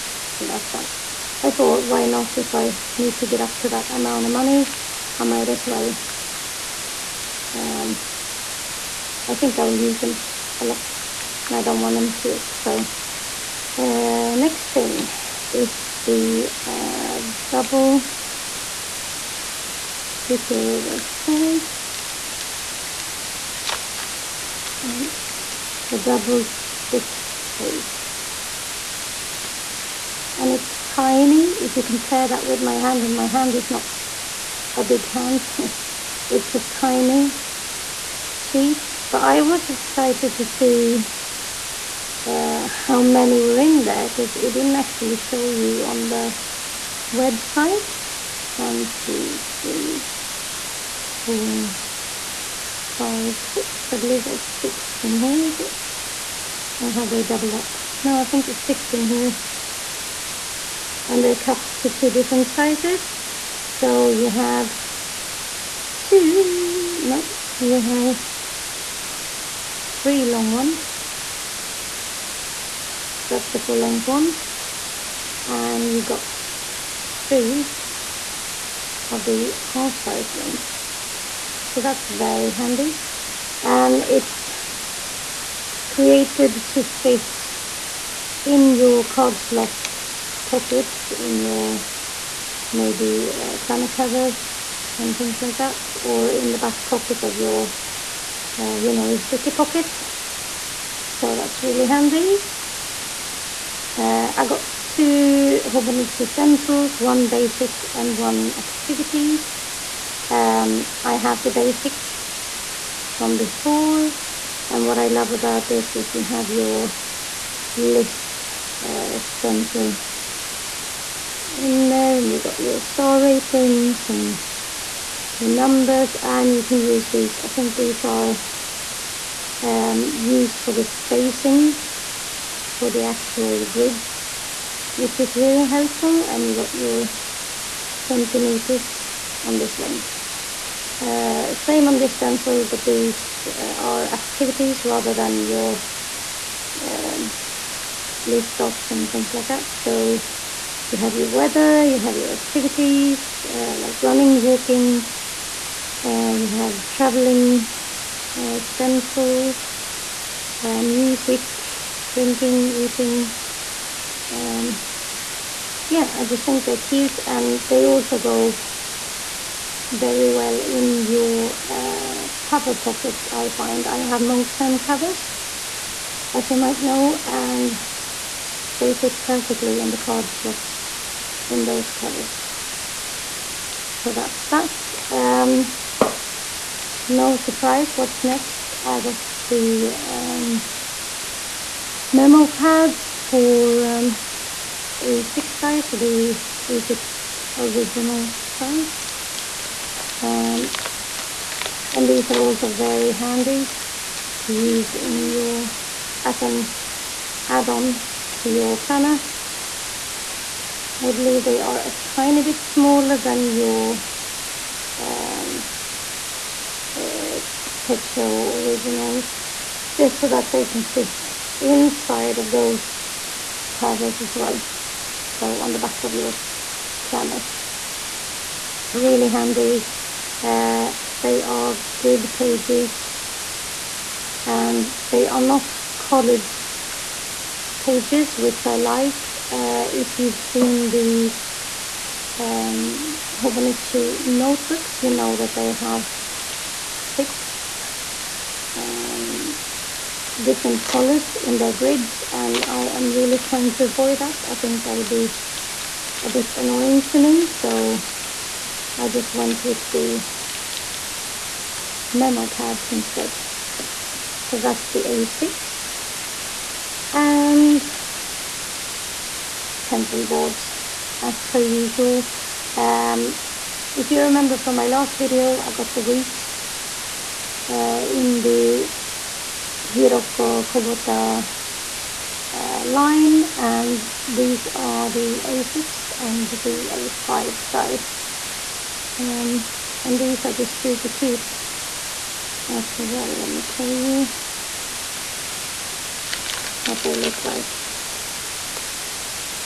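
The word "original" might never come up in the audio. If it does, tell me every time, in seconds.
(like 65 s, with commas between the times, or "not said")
197 s, 218 s.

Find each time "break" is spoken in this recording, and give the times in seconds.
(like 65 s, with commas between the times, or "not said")
not said.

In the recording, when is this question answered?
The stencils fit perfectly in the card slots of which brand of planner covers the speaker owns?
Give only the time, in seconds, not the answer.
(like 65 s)
174 s.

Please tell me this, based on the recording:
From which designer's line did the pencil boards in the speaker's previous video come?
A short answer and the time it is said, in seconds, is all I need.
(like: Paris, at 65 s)
Hiroko Kubota, at 279 s.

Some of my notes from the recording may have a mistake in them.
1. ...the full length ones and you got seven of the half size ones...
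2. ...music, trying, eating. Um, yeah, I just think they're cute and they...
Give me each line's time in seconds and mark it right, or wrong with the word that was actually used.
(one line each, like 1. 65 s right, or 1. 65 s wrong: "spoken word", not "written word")
1. 73 s wrong: "three", not "seven"
2. 160 s wrong: "drinking", not "trying".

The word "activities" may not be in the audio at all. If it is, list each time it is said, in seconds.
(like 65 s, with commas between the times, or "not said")
108 s, 144 s, 152 s.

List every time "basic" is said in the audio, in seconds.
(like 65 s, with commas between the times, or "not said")
107 s, 111 s.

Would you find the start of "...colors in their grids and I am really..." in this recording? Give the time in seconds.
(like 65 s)
250 s.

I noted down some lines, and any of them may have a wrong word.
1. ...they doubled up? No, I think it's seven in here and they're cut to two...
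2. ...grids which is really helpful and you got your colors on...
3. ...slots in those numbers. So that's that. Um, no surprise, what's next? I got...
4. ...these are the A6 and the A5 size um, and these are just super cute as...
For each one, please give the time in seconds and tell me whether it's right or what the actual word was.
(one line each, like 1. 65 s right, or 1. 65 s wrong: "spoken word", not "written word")
1. 57 s wrong: "six", not "seven"
2. 133 s wrong: "centimeters", not "colors"
3. 180 s wrong: "covers", not "numbers"
4. 284 s right.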